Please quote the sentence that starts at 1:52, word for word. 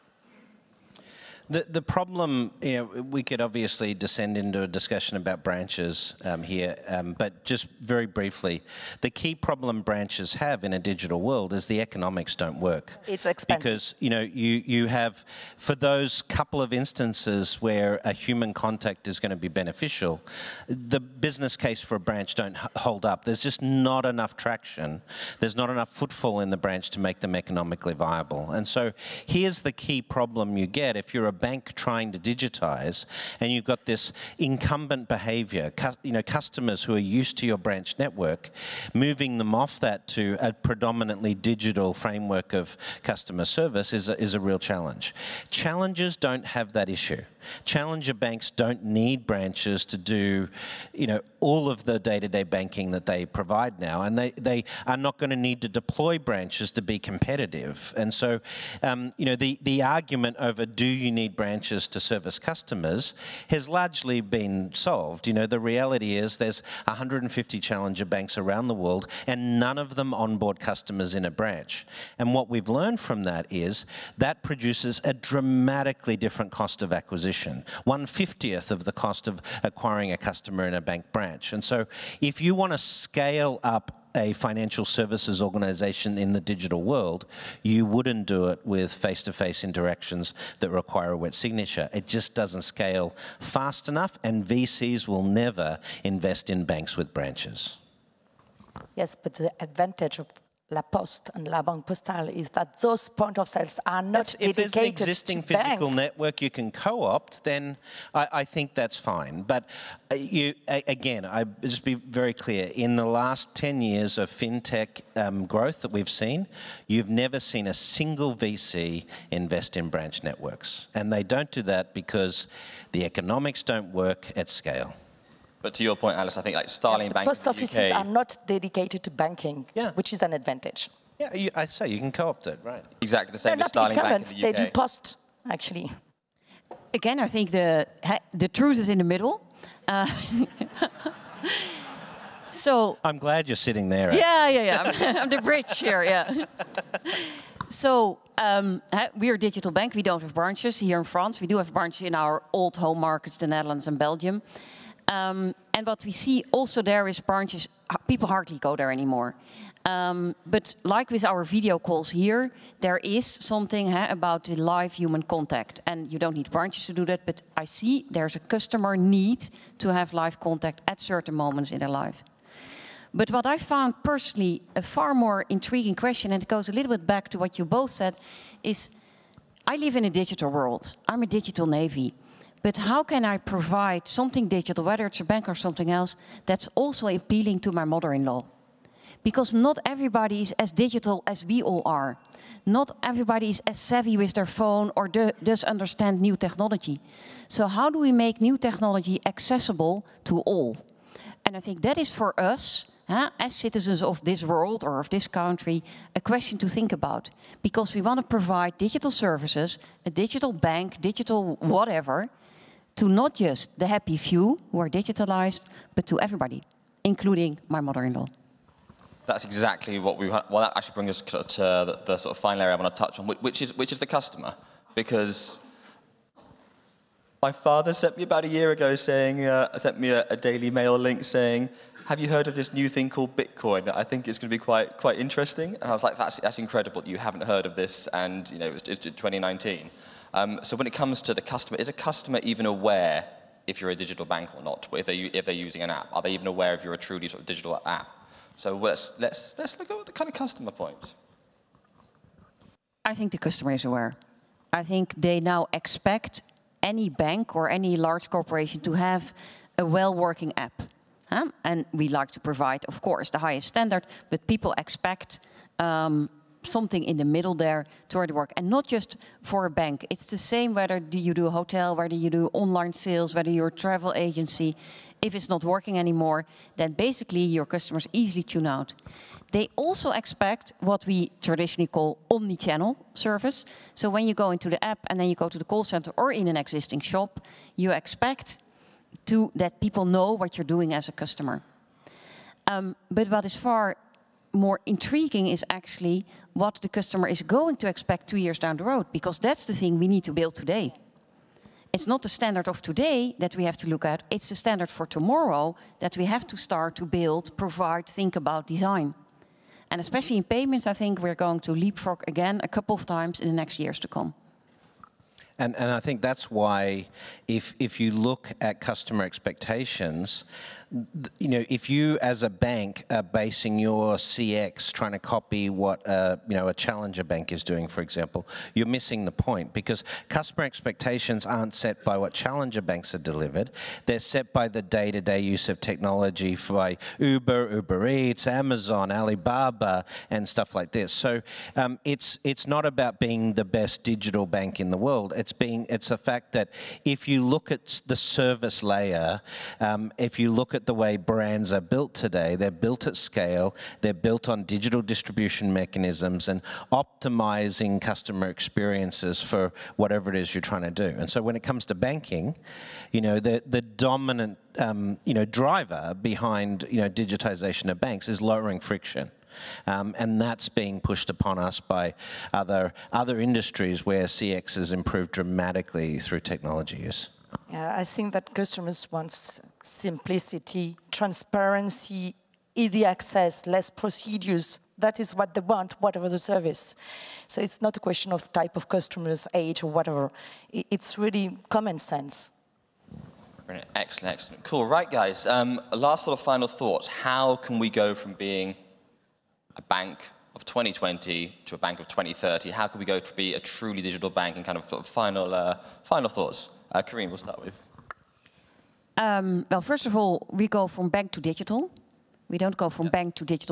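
In the last 10 years of fintech um, growth that we've seen, you've never seen a single VC invest in branch networks.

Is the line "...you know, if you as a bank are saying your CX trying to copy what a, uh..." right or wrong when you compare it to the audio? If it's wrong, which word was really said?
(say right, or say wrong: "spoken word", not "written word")
wrong: "basing", not "saying".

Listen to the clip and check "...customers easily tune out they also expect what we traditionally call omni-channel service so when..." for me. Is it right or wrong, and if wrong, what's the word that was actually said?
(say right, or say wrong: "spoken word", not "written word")
right.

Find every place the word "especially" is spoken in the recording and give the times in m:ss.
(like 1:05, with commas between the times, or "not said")
5:10.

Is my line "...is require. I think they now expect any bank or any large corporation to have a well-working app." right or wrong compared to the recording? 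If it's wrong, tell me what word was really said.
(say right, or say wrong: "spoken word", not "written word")
wrong: "aware", not "require".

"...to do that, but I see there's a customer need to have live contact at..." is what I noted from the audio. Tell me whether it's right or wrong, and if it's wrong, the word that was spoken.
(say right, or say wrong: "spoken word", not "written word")
right.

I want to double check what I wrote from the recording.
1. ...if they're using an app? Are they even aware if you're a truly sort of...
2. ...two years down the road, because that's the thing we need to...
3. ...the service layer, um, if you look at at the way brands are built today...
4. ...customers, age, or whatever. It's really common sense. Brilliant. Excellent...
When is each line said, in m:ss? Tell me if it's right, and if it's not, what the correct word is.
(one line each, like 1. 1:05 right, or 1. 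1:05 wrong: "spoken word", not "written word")
1. 4:05 right
2. 4:58 right
3. 5:48 right
4. 6:28 right.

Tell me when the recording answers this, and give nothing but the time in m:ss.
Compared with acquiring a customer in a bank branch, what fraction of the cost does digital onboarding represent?
1:17.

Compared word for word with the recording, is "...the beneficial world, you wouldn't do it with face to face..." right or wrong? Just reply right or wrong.
wrong.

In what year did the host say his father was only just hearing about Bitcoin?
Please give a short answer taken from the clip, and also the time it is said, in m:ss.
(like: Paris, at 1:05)
2019, at 3:59.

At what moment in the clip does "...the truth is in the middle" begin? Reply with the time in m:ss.
2:18.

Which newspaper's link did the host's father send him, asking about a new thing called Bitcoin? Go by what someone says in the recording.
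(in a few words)
Daily Mail.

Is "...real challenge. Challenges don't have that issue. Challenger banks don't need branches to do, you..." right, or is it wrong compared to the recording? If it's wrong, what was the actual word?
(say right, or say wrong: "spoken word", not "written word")
right.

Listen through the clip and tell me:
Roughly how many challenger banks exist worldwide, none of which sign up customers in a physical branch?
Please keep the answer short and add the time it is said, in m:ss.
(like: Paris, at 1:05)
150, at 1:06.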